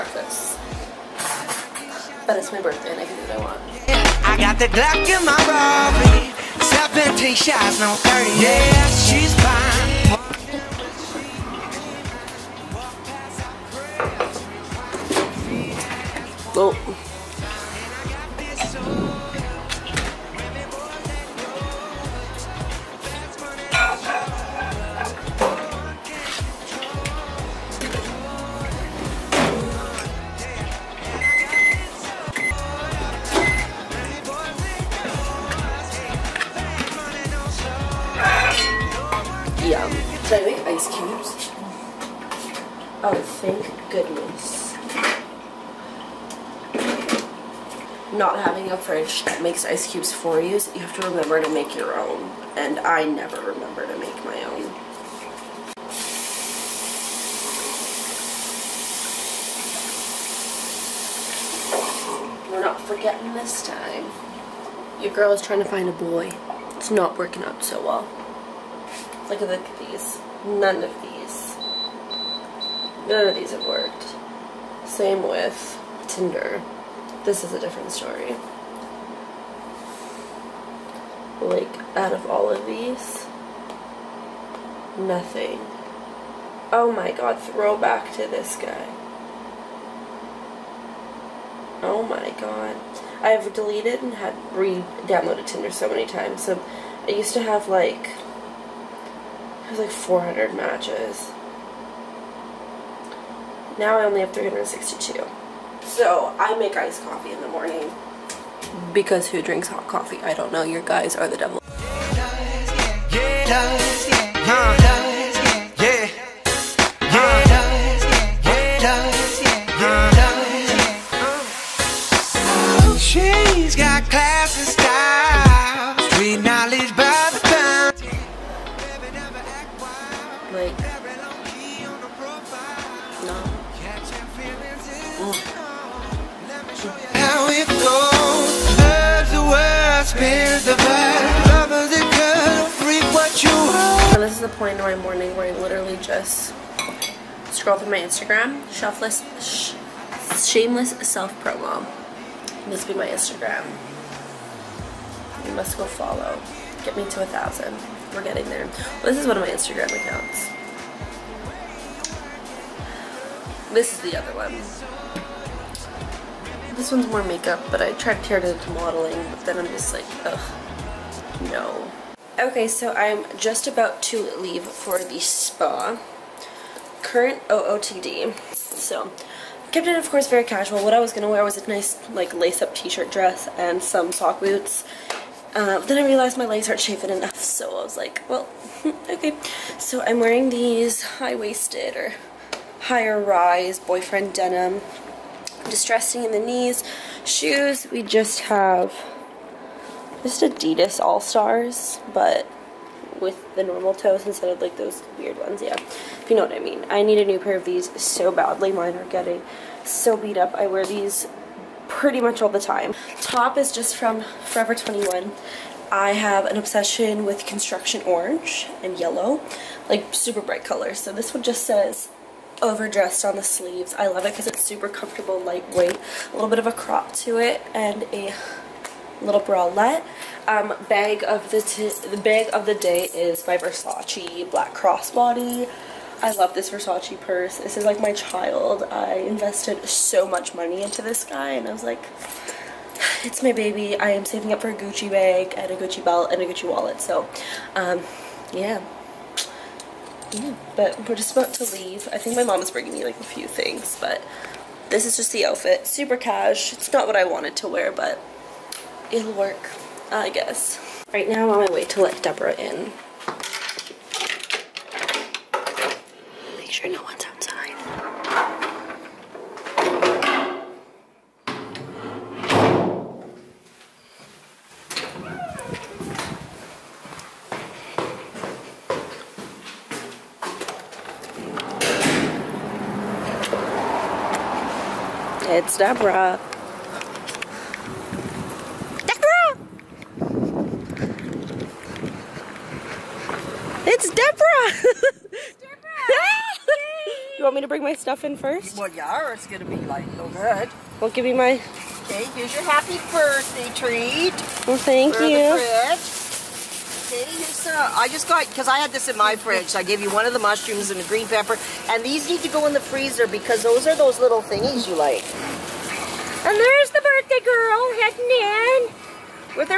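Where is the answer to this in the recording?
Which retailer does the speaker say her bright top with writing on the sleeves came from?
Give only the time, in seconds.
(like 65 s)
214 s.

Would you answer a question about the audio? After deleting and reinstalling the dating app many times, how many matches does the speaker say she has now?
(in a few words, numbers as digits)
362.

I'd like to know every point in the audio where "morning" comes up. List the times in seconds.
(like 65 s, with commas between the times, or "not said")
107 s, 144 s.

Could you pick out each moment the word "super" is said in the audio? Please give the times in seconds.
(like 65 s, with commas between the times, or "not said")
220 s, 224 s, 255 s.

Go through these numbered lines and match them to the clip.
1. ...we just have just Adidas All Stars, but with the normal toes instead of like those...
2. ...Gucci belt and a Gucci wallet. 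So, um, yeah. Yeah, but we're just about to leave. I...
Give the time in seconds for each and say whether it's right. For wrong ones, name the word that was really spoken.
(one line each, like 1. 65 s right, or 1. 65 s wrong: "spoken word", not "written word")
1. 197 s right
2. 245 s right.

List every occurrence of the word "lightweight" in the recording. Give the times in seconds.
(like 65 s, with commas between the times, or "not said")
225 s.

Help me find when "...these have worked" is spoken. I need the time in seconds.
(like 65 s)
73 s.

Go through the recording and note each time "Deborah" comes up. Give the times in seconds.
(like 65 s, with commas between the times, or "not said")
262 s, 285 s.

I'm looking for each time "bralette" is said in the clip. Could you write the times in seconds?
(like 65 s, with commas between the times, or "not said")
229 s.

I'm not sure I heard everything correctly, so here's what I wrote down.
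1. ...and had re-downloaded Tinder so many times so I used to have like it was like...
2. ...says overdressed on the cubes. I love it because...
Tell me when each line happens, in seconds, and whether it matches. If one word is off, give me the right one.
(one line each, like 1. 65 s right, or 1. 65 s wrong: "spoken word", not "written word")
1. 94 s right
2. 221 s wrong: "sleeves", not "cubes".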